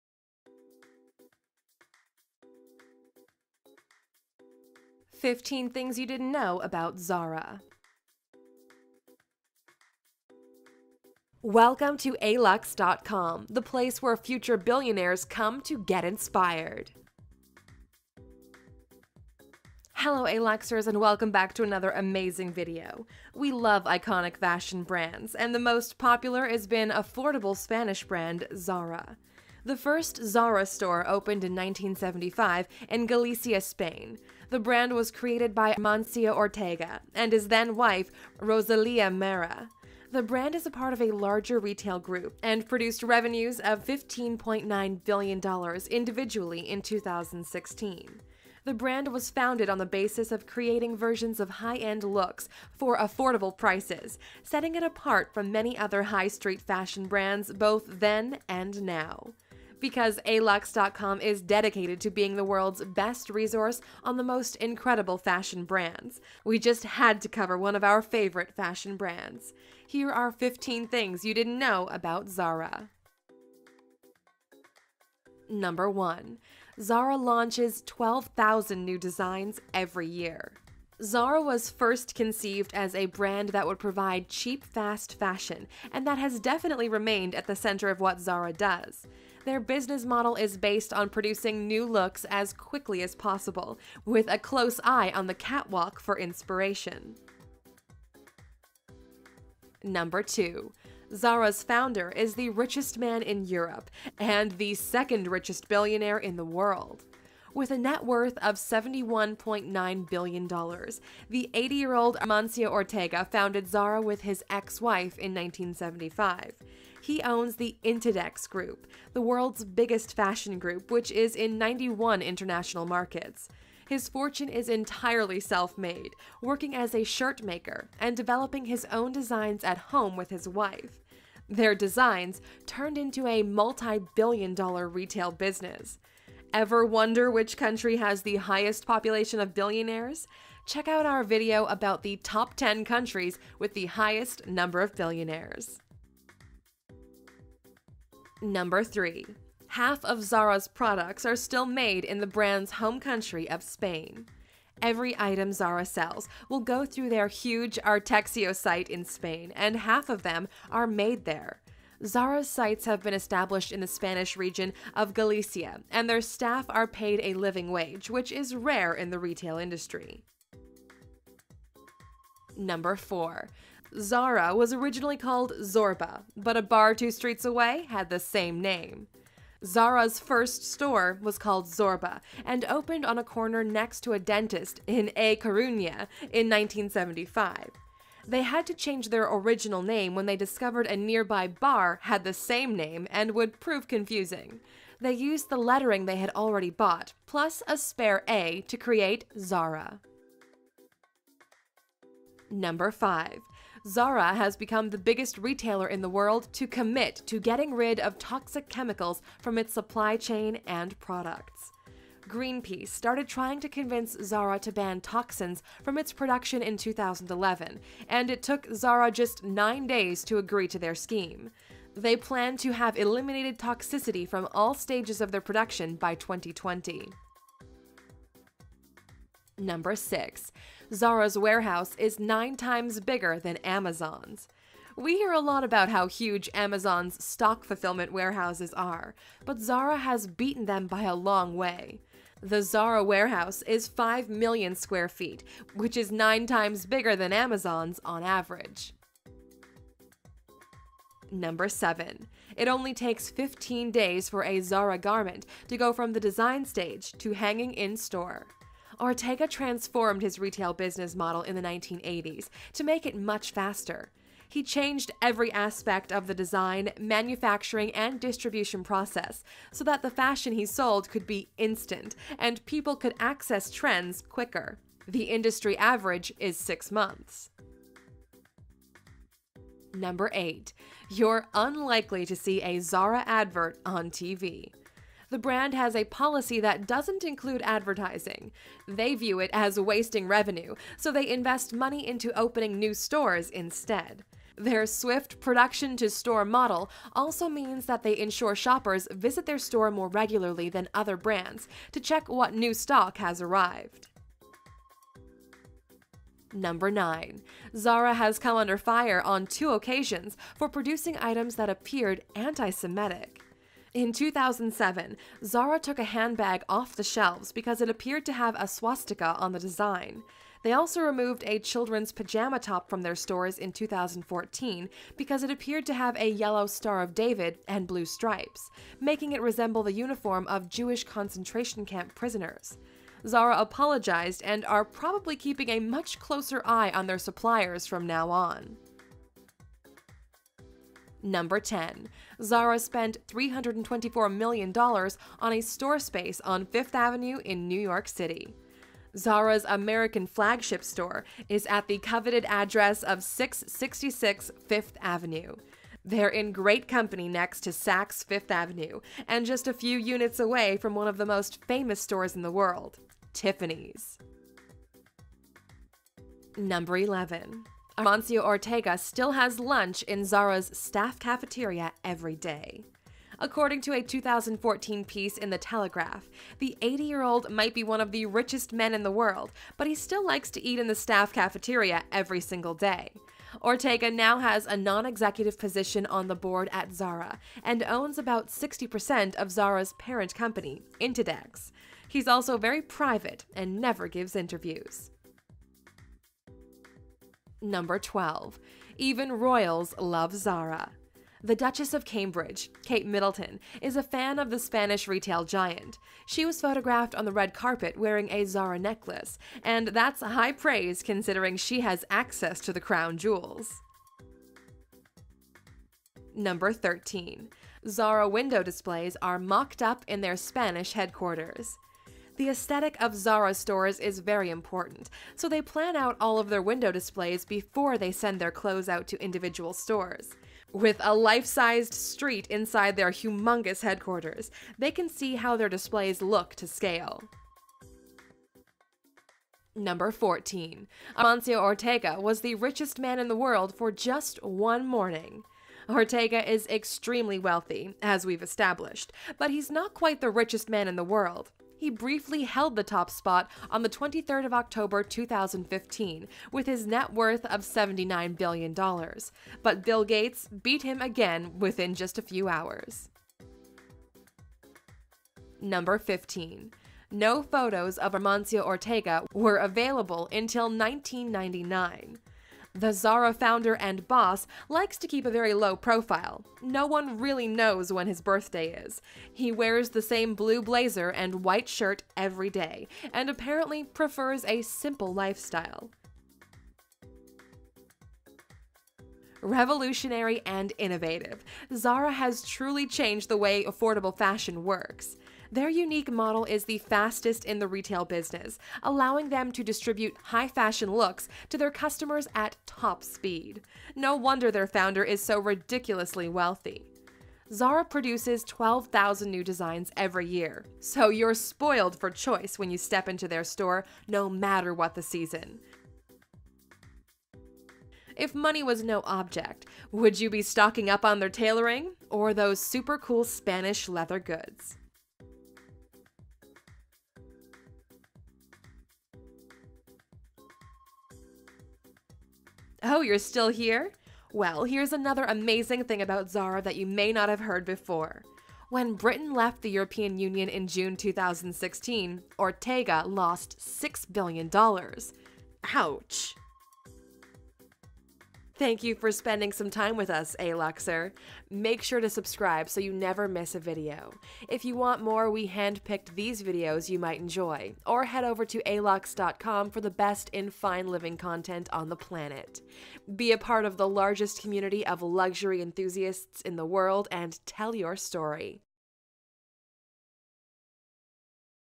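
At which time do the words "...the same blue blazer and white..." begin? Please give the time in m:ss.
7:59.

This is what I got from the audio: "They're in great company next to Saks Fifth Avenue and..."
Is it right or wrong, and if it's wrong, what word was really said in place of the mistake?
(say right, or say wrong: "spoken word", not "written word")
right.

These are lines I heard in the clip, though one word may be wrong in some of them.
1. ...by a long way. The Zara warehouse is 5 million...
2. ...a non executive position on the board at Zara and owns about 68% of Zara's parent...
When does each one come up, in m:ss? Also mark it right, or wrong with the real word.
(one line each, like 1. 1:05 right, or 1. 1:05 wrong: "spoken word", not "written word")
1. 4:00 right
2. 6:24 wrong: "60", not "68".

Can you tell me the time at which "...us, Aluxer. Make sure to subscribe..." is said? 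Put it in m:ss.
9:10.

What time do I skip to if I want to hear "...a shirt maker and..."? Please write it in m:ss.
2:06.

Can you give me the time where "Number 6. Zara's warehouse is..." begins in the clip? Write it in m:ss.
3:49.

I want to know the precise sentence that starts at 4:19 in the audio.
Ortega transformed his retail business model in the 1980s to make it much faster.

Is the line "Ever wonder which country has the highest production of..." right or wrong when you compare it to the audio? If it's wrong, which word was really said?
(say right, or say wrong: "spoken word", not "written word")
wrong: "population", not "production".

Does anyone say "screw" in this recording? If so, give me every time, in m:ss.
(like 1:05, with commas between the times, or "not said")
not said.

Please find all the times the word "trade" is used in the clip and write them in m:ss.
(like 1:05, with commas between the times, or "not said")
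not said.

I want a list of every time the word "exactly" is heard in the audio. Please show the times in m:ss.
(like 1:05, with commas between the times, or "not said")
not said.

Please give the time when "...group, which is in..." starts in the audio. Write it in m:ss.
2:00.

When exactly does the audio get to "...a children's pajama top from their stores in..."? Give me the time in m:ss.
5:21.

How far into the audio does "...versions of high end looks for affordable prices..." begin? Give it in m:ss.
0:50.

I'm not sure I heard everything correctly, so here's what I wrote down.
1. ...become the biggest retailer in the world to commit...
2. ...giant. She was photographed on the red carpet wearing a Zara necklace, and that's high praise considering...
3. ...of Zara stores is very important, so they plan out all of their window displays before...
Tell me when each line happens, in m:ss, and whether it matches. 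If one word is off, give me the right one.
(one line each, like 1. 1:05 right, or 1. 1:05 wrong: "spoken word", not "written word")
1. 3:24 right
2. 6:45 right
3. 7:03 right.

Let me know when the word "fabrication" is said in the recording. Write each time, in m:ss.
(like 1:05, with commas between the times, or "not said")
not said.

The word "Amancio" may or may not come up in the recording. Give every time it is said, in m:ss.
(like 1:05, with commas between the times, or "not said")
0:35, 1:52, 6:07, 7:21, 7:48.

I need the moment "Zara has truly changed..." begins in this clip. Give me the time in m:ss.
8:11.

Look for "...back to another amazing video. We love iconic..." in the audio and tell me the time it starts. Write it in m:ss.
0:21.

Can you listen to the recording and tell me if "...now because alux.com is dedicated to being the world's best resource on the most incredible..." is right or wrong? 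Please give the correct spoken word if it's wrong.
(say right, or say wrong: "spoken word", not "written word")
right.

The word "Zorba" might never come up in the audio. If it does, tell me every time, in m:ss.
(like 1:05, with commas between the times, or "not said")
2:55, 3:01.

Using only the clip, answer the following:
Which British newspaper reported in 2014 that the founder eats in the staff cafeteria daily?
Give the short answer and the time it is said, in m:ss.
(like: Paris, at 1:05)
The Telegraph, at 6:15.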